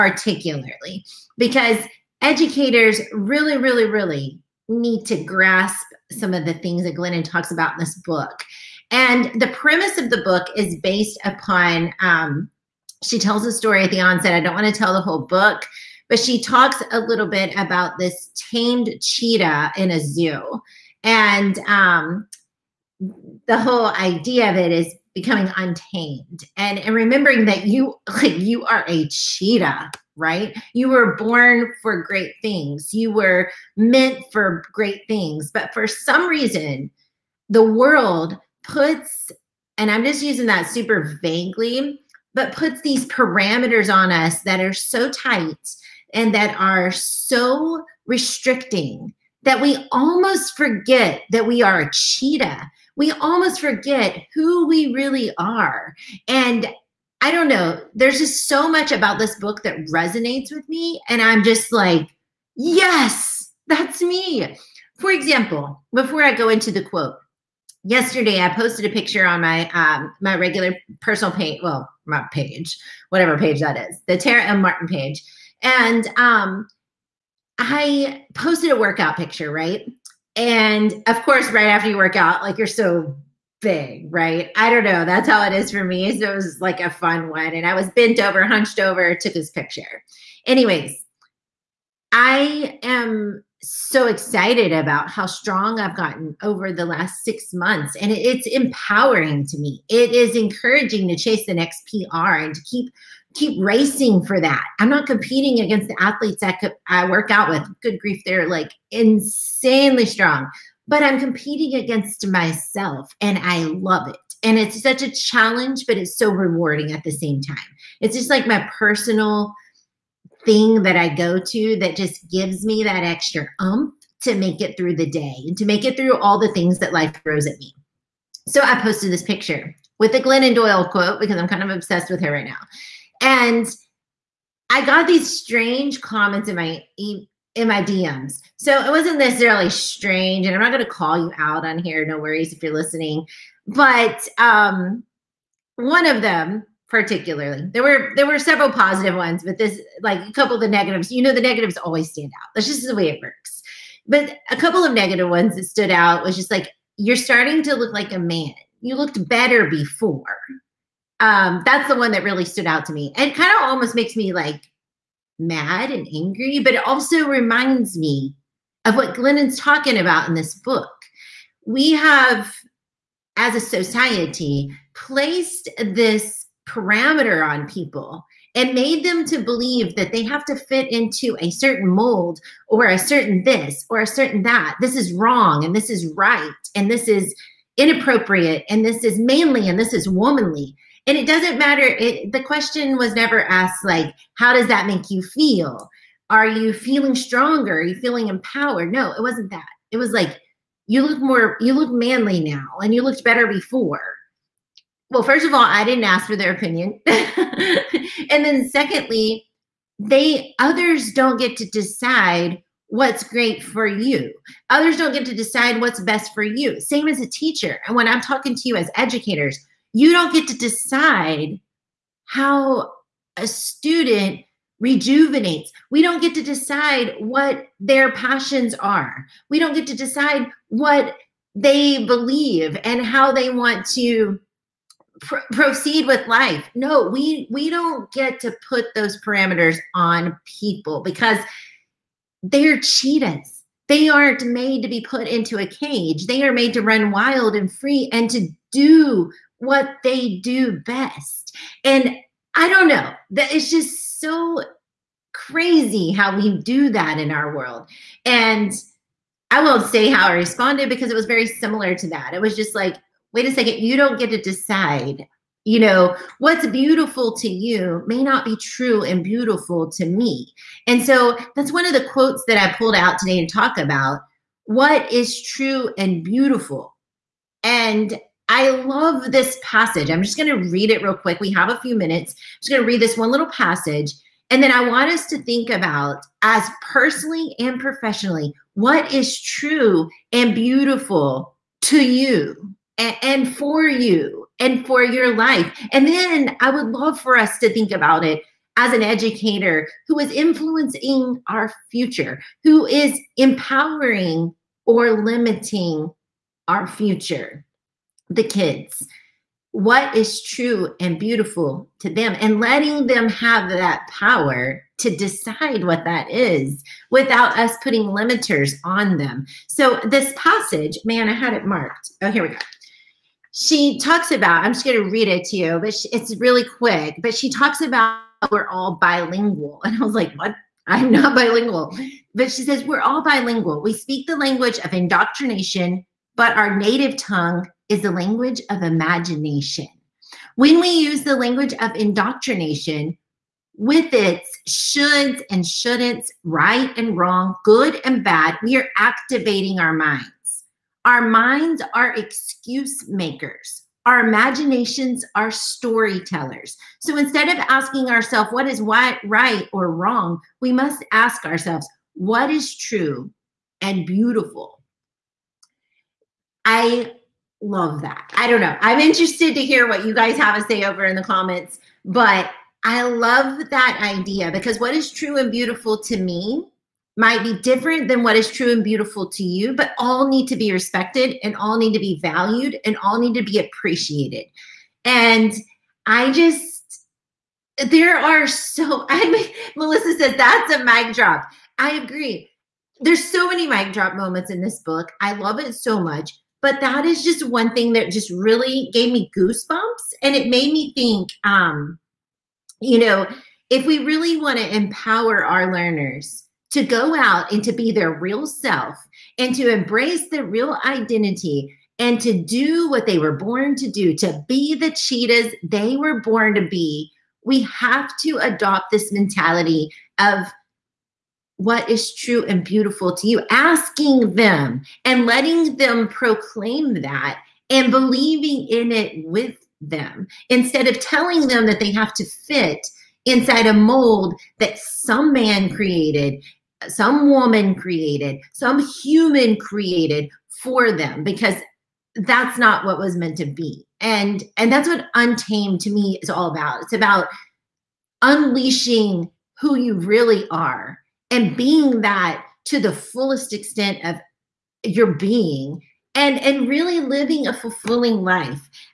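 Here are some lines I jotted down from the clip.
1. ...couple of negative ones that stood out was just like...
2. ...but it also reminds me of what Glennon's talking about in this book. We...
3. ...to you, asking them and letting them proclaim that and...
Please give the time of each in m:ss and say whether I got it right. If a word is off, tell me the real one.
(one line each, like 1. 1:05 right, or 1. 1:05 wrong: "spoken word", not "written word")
1. 2:34 right
2. 2:46 right
3. 7:03 right.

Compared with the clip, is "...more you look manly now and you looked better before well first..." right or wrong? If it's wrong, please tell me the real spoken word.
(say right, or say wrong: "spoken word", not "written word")
right.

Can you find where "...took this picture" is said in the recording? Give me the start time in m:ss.
1:29.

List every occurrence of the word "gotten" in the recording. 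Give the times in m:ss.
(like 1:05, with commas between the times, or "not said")
1:35.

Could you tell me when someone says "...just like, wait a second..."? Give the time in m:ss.
4:22.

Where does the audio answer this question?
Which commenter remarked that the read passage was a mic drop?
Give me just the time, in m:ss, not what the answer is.
6:29.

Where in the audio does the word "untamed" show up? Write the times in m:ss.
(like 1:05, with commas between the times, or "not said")
0:25, 7:25.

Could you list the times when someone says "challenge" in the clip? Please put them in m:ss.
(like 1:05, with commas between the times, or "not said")
1:55.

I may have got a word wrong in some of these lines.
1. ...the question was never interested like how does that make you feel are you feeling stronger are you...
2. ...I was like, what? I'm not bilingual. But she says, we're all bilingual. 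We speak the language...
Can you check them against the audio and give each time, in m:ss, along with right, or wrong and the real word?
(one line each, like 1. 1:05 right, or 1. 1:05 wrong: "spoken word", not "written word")
1. 3:12 wrong: "asked", not "interested"
2. 5:30 right.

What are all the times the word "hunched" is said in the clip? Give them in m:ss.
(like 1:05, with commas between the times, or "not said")
1:28.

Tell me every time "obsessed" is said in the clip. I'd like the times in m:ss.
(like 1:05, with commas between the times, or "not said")
2:11.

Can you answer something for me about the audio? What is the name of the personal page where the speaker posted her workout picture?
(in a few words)
Tara M. Martin.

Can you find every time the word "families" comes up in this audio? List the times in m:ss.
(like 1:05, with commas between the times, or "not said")
not said.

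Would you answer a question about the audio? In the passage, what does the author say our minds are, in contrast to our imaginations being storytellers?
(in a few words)
Excuse makers.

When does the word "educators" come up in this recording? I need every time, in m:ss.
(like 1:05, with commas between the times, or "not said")
0:02, 3:38, 4:59.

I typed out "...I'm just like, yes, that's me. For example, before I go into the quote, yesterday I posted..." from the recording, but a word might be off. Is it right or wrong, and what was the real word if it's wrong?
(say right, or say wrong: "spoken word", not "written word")
right.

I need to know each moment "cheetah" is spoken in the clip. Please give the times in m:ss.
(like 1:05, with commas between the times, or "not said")
0:19, 0:29, 0:51, 4:02, 6:54.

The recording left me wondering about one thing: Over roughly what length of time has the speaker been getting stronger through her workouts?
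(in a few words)
6 months.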